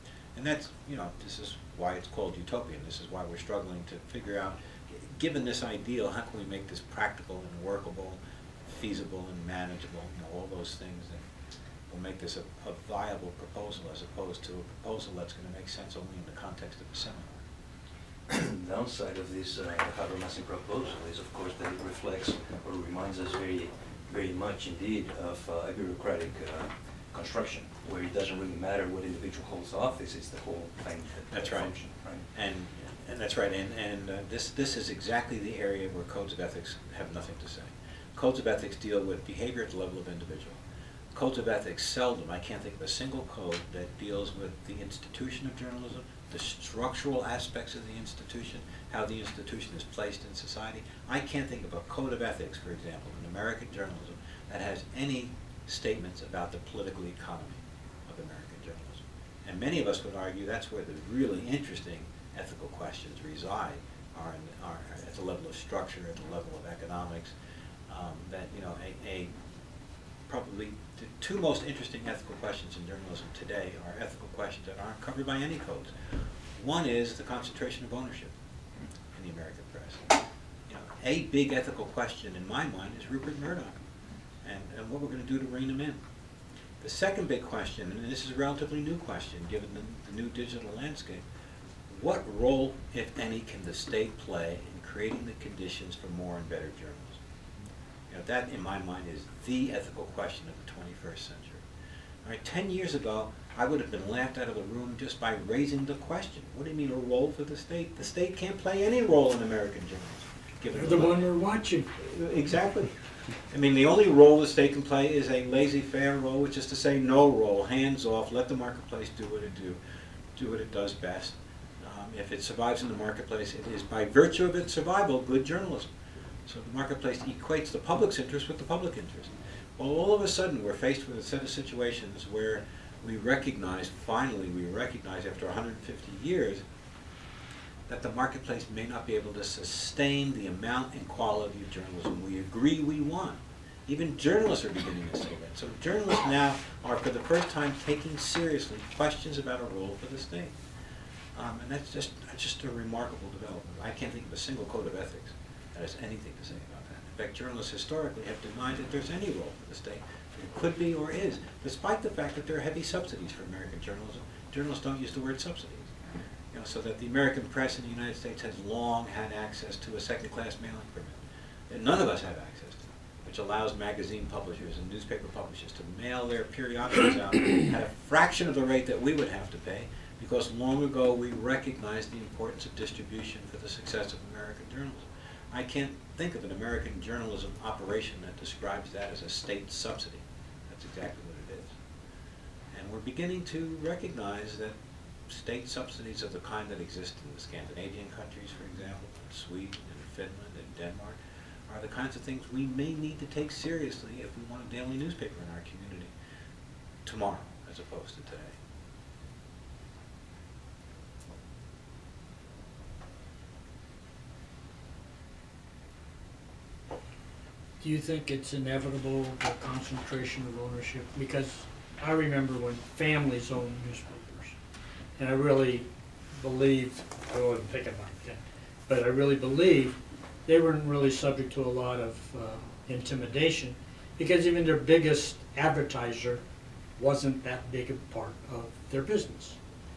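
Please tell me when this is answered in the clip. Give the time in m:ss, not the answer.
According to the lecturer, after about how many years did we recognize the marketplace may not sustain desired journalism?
2:15.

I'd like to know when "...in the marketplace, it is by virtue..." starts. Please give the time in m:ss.
2:02.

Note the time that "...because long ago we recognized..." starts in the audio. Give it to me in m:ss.
3:00.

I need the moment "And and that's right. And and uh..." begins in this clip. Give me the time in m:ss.
0:32.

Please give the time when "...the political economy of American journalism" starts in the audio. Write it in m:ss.
0:56.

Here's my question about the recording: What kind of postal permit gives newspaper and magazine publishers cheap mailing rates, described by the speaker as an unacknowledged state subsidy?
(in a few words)
Second-class mailing permit.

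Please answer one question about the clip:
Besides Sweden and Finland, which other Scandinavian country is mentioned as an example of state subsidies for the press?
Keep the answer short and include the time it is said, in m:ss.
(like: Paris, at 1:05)
Denmark, at 3:20.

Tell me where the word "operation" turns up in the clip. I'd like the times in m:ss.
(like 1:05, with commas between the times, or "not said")
3:07.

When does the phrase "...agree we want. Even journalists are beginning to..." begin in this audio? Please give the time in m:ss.
2:22.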